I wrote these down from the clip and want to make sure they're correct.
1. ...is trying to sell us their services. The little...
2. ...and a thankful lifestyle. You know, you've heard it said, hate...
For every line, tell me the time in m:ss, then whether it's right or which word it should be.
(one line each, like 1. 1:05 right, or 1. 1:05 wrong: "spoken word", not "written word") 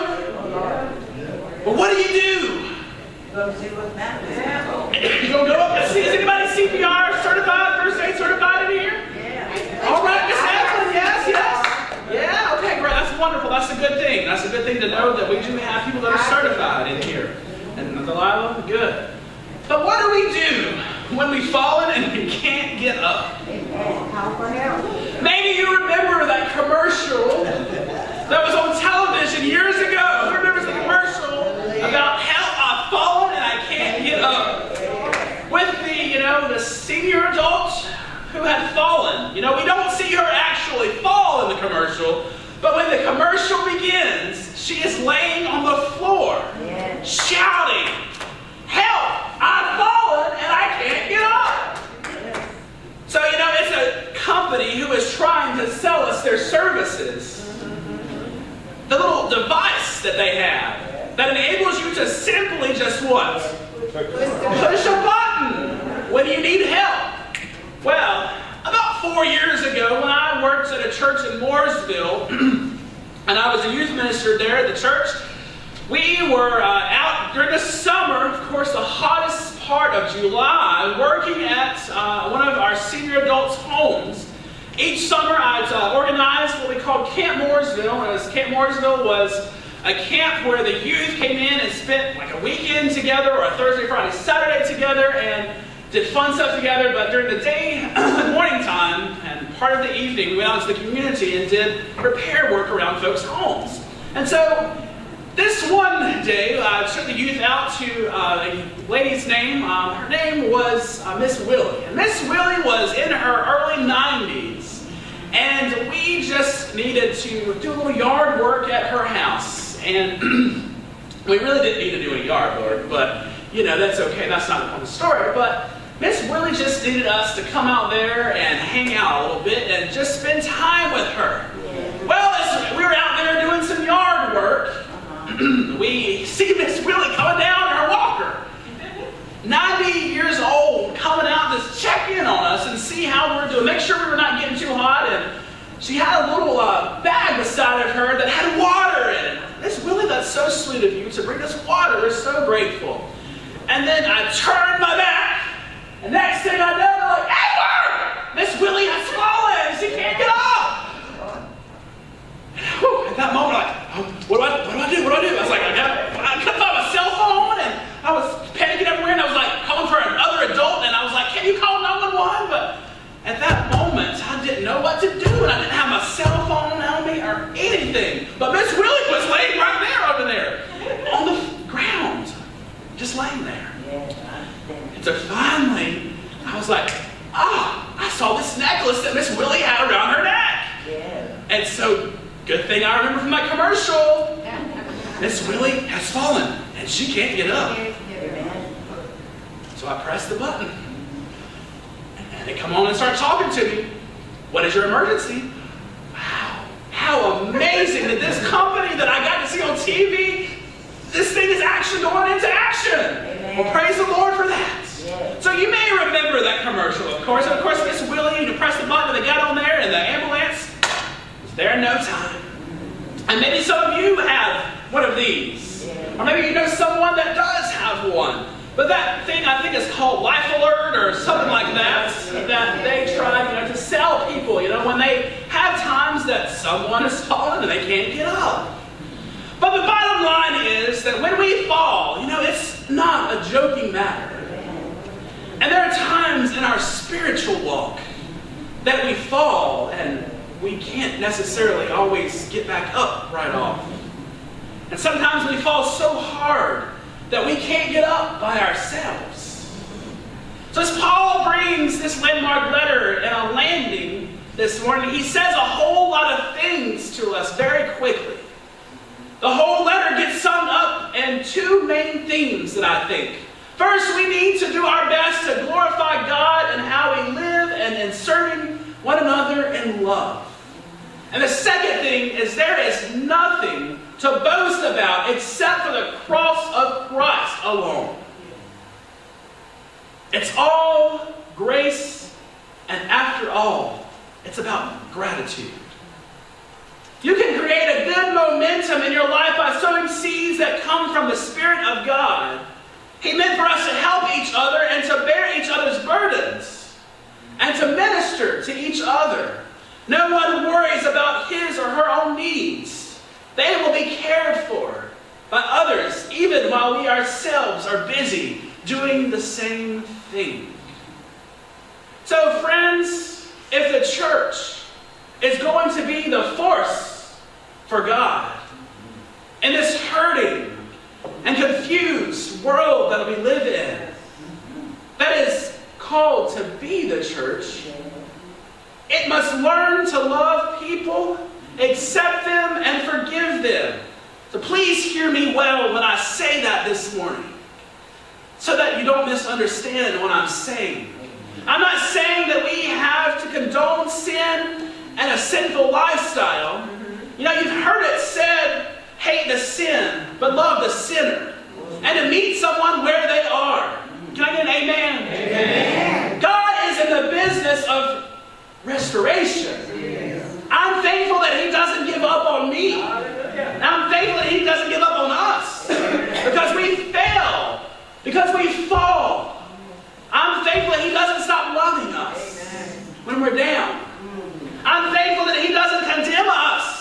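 1. 0:54 right
2. 5:55 wrong: "sinful", not "thankful".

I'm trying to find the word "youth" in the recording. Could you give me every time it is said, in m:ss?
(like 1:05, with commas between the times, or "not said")
1:13, 1:30, 1:47.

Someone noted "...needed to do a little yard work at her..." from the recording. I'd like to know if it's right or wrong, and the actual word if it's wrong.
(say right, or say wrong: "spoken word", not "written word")
right.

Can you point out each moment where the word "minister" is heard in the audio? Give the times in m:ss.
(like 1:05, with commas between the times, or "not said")
1:13, 5:07.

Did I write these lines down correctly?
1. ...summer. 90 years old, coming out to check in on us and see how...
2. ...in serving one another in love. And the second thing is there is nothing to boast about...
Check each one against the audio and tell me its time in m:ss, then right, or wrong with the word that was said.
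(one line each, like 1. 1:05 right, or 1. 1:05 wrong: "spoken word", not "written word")
1. 2:17 wrong: "walker", not "summer"
2. 4:37 right.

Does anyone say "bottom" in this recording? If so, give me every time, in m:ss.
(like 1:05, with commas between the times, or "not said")
3:59.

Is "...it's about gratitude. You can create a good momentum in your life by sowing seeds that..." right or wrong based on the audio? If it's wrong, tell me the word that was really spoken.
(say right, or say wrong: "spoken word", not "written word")
right.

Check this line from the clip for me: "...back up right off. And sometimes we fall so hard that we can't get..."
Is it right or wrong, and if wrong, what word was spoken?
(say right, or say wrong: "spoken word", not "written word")
right.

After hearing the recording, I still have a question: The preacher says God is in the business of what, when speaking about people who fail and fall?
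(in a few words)
Restoration.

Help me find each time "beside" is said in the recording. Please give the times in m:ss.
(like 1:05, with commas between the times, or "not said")
2:27.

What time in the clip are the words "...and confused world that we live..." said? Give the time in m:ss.
5:31.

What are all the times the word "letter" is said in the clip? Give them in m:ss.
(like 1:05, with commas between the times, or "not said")
4:22, 4:29.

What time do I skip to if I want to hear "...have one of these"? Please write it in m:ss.
3:44.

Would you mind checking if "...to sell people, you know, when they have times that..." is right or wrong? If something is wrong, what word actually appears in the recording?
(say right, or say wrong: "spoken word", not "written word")
right.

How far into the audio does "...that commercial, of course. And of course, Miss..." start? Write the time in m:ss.
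3:36.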